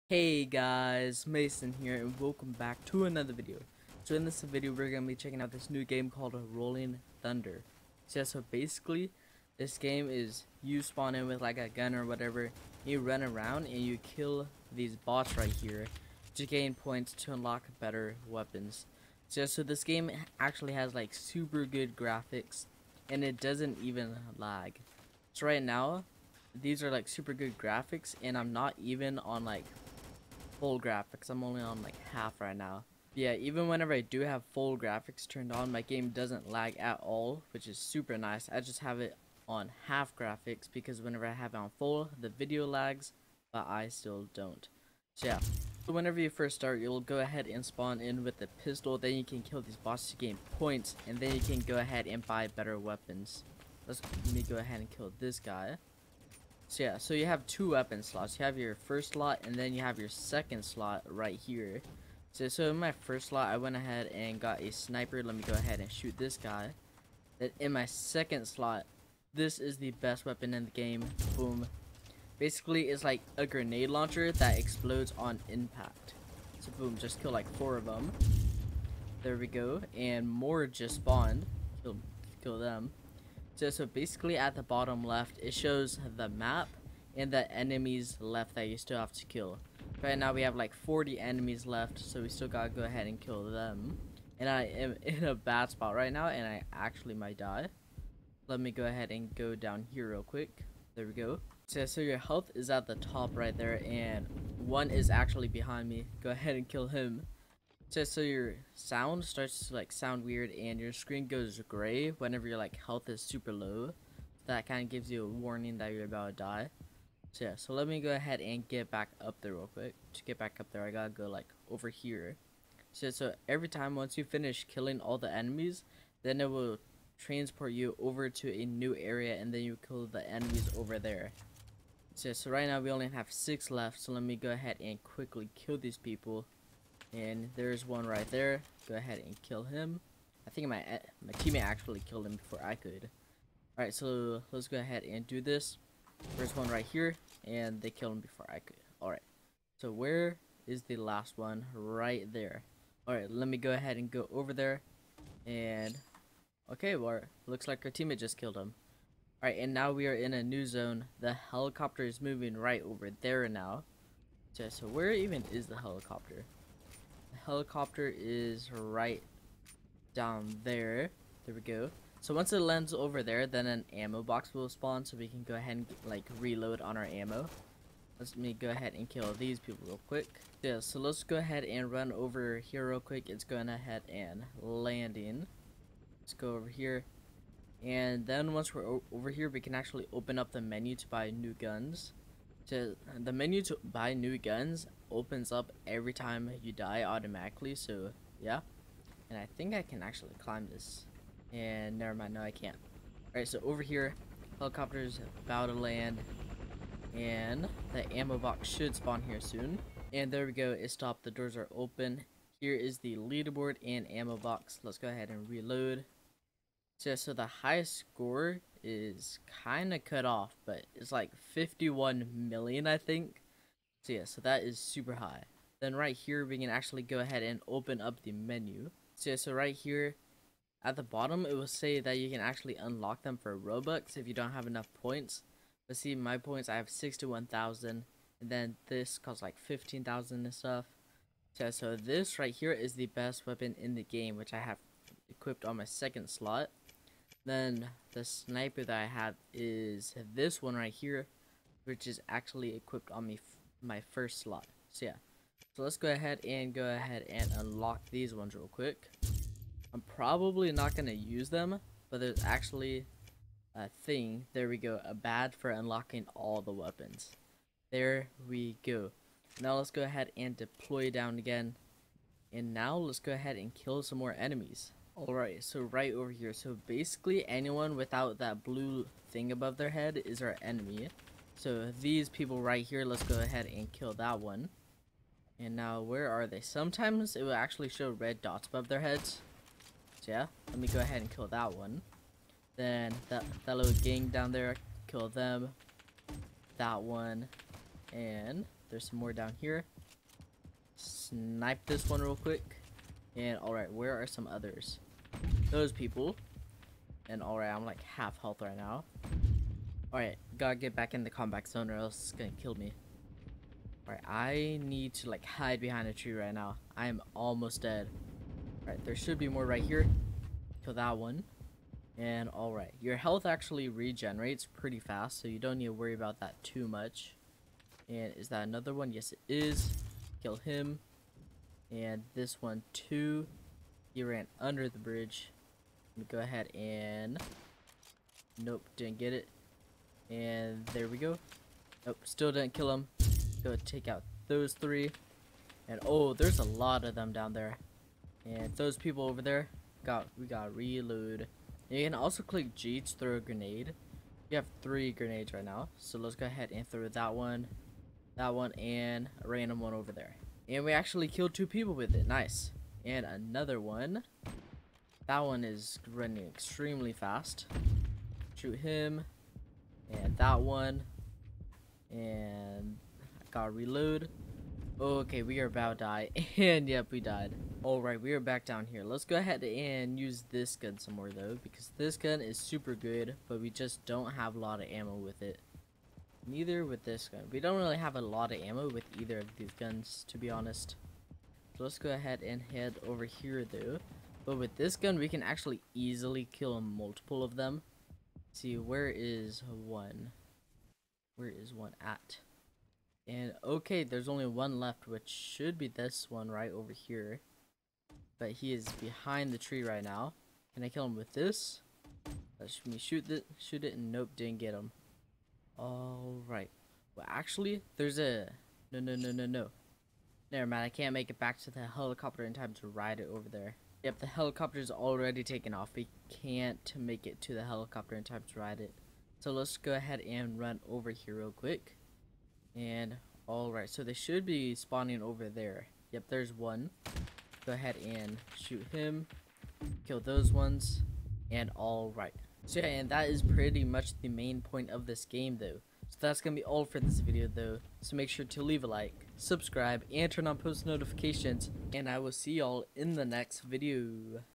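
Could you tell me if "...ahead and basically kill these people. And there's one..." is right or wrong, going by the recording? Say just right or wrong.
wrong.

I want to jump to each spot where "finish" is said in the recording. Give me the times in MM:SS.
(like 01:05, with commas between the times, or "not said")
02:04.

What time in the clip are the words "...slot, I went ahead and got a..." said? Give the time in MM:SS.
01:03.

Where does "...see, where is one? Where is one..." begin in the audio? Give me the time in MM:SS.
06:38.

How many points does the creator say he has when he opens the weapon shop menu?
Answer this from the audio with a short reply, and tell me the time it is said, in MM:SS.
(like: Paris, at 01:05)
61,000, at 03:56.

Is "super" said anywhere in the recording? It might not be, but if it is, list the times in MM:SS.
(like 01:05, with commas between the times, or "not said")
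00:21, 00:27, 00:37, 01:53, 03:44, 06:22.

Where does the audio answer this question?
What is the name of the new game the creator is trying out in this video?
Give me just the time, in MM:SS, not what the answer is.
00:06.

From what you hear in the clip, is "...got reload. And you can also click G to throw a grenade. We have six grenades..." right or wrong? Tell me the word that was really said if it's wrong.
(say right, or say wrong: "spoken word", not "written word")
wrong: "three", not "six".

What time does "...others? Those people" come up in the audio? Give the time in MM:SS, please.
05:04.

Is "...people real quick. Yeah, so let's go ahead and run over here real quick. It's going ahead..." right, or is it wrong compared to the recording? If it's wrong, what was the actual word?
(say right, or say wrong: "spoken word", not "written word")
right.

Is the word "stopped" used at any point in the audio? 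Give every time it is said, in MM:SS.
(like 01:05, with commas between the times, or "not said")
03:30.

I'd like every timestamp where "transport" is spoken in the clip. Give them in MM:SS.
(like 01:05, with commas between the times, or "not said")
02:07.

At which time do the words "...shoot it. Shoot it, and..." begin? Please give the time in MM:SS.
06:52.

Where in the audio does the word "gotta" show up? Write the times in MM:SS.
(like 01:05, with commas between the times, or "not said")
01:32, 02:00, 05:10, 06:13.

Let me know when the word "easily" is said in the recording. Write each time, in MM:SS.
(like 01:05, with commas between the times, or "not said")
06:35.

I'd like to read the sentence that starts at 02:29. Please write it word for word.
Alright, so where is the last one?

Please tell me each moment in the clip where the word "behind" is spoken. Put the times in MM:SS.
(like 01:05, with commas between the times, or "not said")
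01:45, 05:15, 06:48.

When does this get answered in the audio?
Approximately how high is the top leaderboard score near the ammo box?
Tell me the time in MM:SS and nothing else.
03:41.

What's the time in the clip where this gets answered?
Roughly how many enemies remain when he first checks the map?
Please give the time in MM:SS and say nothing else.
01:30.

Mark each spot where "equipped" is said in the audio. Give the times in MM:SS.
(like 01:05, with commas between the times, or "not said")
04:05, 04:12.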